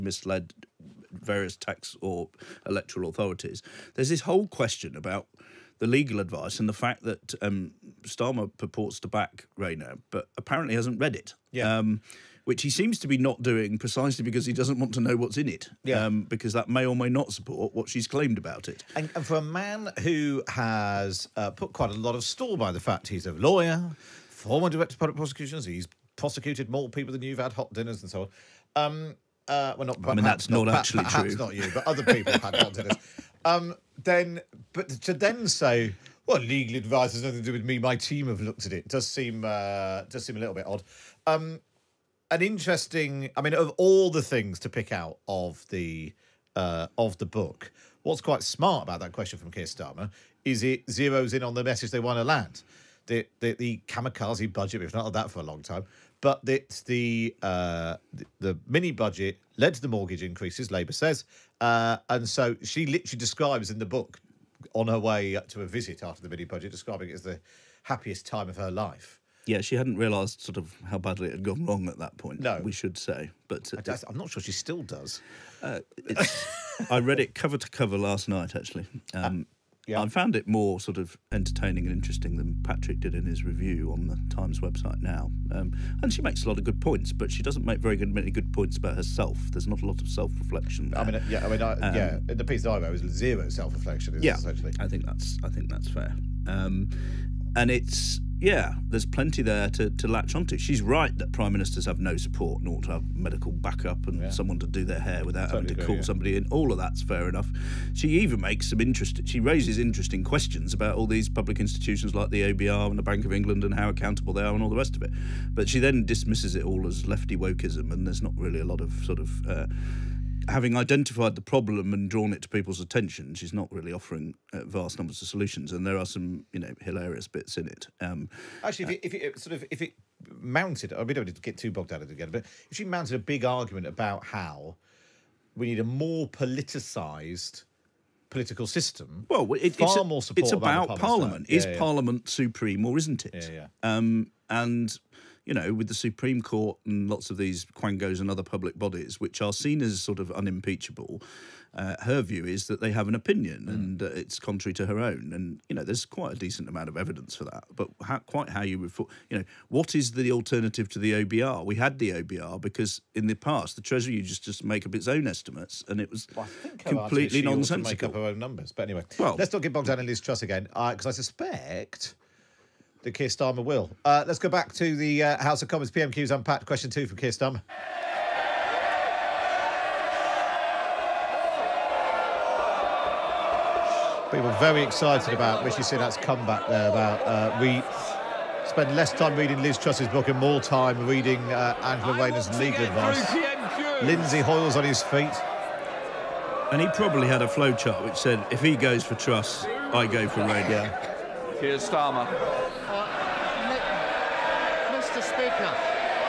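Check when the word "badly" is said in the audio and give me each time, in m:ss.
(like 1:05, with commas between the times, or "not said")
1:10.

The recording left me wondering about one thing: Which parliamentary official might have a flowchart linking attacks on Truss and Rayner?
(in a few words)
Lindsay Hoyle.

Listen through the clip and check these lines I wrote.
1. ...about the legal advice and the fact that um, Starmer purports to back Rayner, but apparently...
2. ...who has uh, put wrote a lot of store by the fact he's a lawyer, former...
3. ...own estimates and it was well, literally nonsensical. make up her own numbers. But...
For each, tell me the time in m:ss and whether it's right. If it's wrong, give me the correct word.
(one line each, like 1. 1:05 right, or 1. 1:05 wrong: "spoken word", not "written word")
1. 0:04 right
2. 0:20 wrong: "quite", not "wrote"
3. 2:45 wrong: "completely", not "literally".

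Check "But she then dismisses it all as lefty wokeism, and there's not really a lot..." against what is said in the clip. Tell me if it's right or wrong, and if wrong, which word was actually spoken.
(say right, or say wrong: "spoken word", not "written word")
right.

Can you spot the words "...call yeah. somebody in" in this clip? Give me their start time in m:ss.
1:45.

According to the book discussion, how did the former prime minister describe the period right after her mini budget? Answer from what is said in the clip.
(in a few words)
Happiest time of her life.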